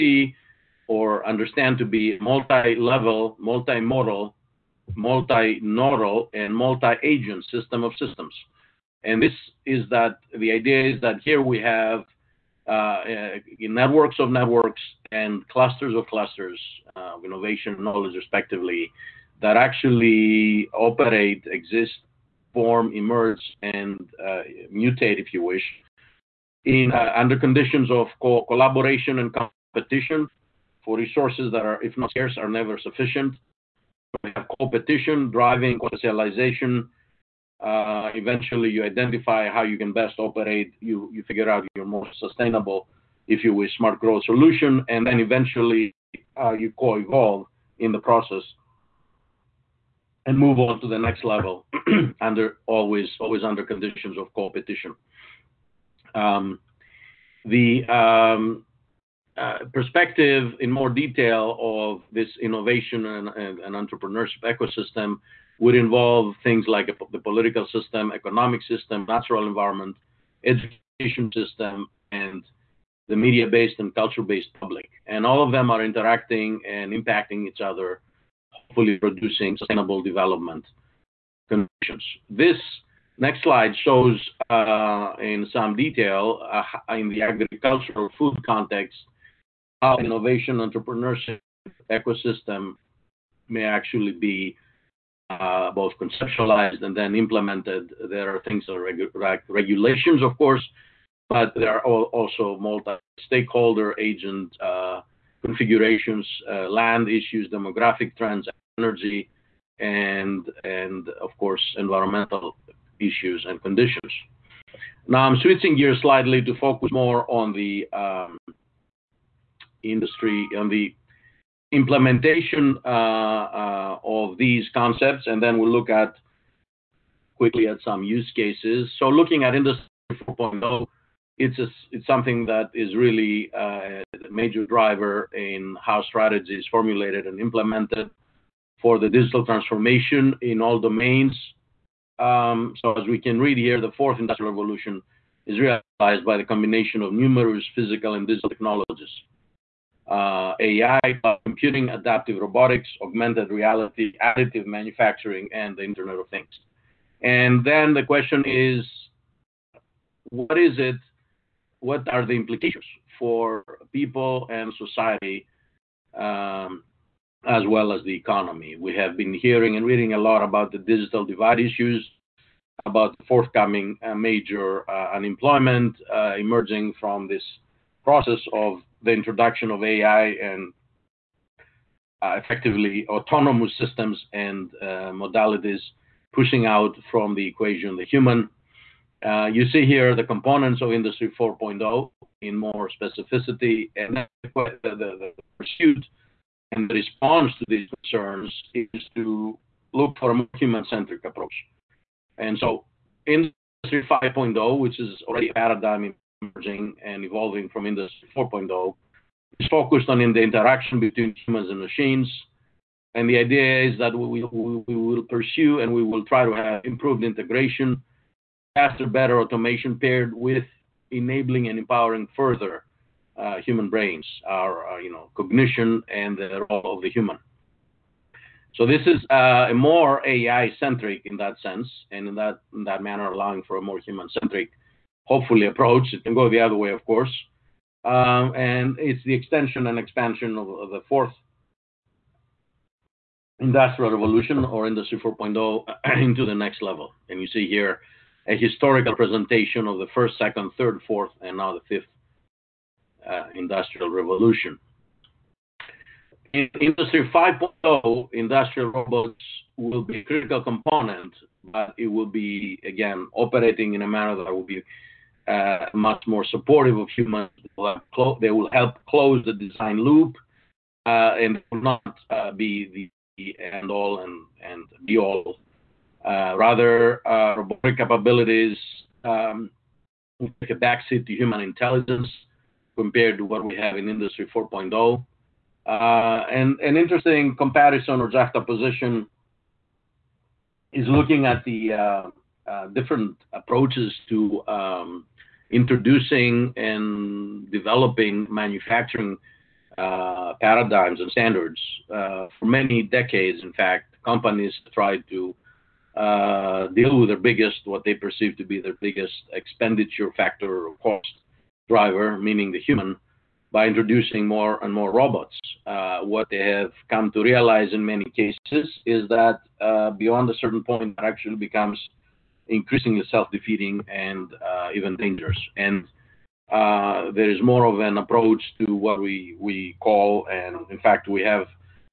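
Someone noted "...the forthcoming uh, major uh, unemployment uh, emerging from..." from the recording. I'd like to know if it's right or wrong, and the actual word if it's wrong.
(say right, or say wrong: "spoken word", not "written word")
right.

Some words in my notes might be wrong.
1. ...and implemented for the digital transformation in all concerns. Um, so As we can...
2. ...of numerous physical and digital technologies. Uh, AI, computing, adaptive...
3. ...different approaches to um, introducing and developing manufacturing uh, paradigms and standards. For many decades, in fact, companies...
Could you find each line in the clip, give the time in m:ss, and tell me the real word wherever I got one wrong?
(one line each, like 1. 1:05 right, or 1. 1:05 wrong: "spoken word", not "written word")
1. 2:17 wrong: "domains", not "concerns"
2. 2:27 right
3. 4:52 right.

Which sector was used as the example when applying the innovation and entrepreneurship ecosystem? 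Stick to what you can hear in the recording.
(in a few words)
Agricultural food.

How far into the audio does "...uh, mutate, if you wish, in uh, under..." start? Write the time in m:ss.
0:24.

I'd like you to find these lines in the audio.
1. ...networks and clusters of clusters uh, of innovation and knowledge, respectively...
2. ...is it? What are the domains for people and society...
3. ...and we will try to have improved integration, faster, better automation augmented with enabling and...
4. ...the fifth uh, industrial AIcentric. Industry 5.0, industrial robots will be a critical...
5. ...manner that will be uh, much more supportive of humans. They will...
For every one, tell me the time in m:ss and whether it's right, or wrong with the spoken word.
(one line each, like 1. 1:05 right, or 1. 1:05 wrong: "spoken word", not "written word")
1. 0:14 right
2. 2:40 wrong: "implications", not "domains"
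3. 3:35 wrong: "paired", not "augmented"
4. 4:11 wrong: "Revolution", not "AIcentric"
5. 4:24 right.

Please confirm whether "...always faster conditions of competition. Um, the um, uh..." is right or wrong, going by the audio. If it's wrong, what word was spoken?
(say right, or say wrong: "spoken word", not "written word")
wrong: "under", not "faster".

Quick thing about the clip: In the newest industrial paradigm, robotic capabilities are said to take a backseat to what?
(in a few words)
Human intelligence.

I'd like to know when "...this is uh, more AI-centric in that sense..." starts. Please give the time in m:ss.
3:48.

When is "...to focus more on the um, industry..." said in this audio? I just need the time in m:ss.
1:56.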